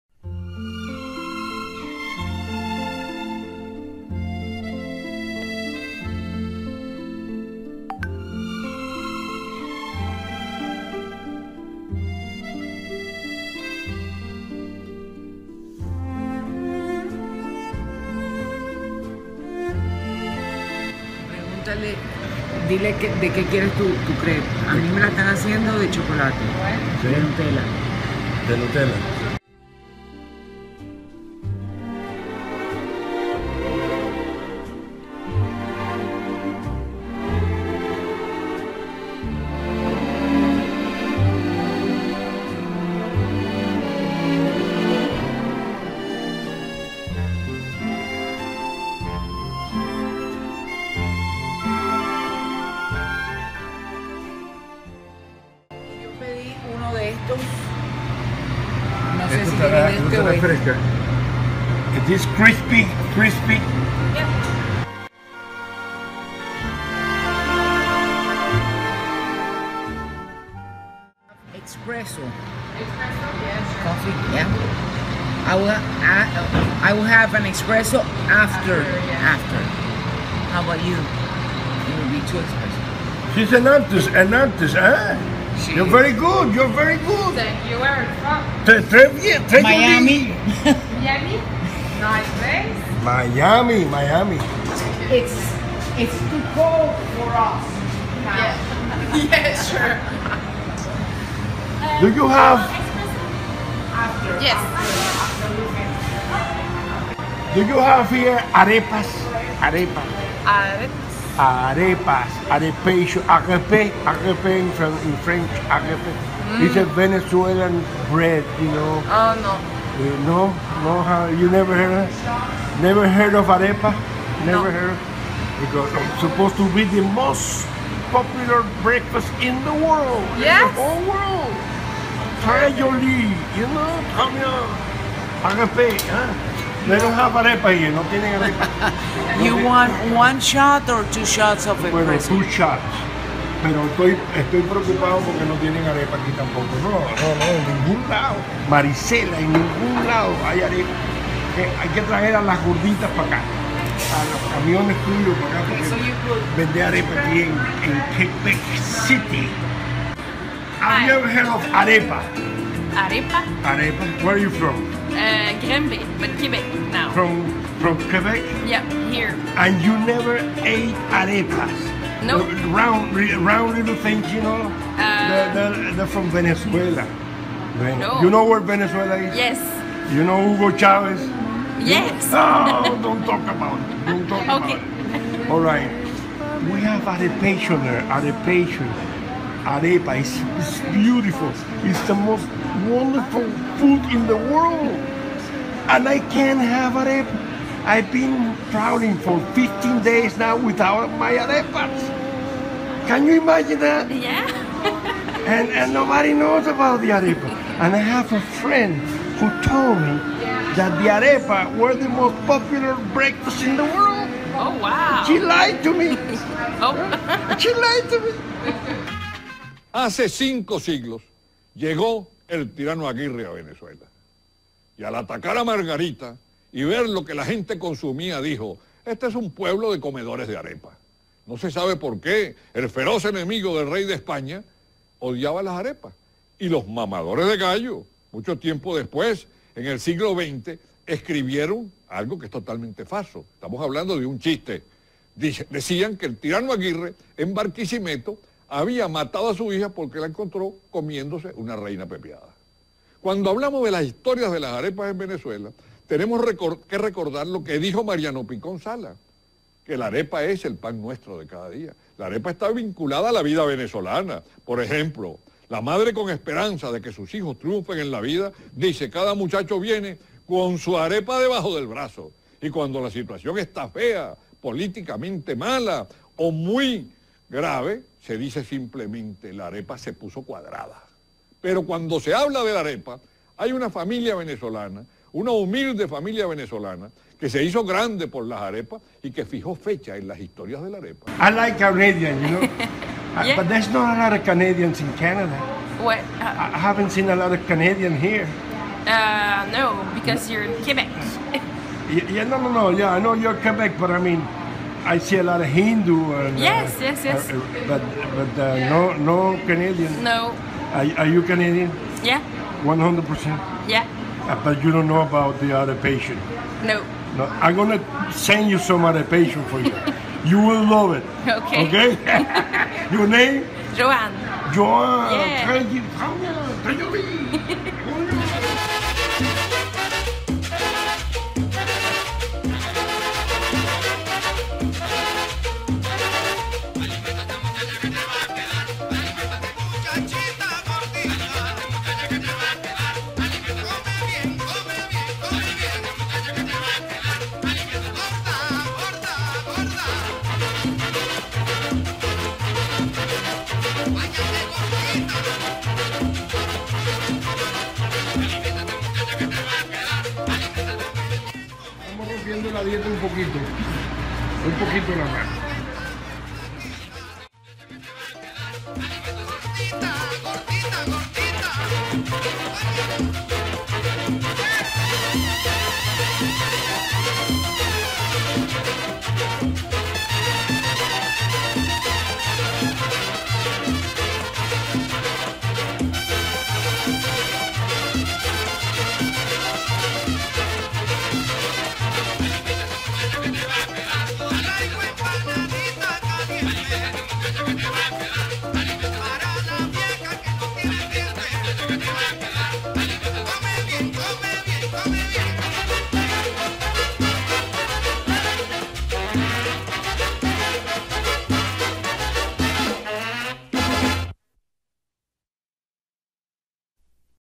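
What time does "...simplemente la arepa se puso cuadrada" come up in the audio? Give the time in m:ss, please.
4:38.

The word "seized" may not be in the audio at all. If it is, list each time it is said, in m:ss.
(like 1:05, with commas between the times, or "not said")
not said.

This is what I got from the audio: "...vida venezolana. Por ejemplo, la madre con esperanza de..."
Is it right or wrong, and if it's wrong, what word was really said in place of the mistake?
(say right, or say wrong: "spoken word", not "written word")
right.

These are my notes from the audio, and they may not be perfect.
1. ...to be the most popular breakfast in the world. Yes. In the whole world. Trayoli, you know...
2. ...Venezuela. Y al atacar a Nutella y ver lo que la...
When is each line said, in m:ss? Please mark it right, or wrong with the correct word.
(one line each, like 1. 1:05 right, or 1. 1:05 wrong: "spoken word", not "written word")
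1. 2:06 right
2. 3:43 wrong: "Margarita", not "Nutella".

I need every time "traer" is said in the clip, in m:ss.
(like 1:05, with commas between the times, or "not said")
2:32.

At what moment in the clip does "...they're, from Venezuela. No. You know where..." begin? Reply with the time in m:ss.
2:55.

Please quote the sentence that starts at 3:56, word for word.
Y los mamadores de gallo, mucho tiempo después, en el siglo XX, escribieron algo que es totalmente falso.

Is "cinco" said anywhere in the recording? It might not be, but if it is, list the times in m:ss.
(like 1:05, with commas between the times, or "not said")
3:40.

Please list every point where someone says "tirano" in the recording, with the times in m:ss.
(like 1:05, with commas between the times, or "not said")
3:42, 4:06.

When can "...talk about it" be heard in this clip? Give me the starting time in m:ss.
3:03.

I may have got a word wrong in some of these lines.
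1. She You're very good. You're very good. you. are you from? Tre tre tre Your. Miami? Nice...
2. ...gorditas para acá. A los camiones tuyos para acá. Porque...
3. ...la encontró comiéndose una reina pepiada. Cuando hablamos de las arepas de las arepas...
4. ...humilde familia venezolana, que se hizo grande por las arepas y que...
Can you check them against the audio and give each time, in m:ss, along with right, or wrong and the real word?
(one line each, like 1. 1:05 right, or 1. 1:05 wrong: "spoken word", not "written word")
1. 1:25 wrong: "Miami", not "Your"
2. 2:32 right
3. 4:10 wrong: "historias", not "arepas"
4. 4:45 right.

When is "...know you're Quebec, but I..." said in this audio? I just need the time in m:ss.
5:03.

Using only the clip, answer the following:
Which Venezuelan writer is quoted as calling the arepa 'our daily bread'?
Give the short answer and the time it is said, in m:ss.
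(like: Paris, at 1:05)
Mariano Picón Sala, at 4:18.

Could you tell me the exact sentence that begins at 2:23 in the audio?
Pero estoy, estoy preocupado porque no tienen arepa aquí tampoco.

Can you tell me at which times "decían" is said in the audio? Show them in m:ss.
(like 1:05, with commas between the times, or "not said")
4:05.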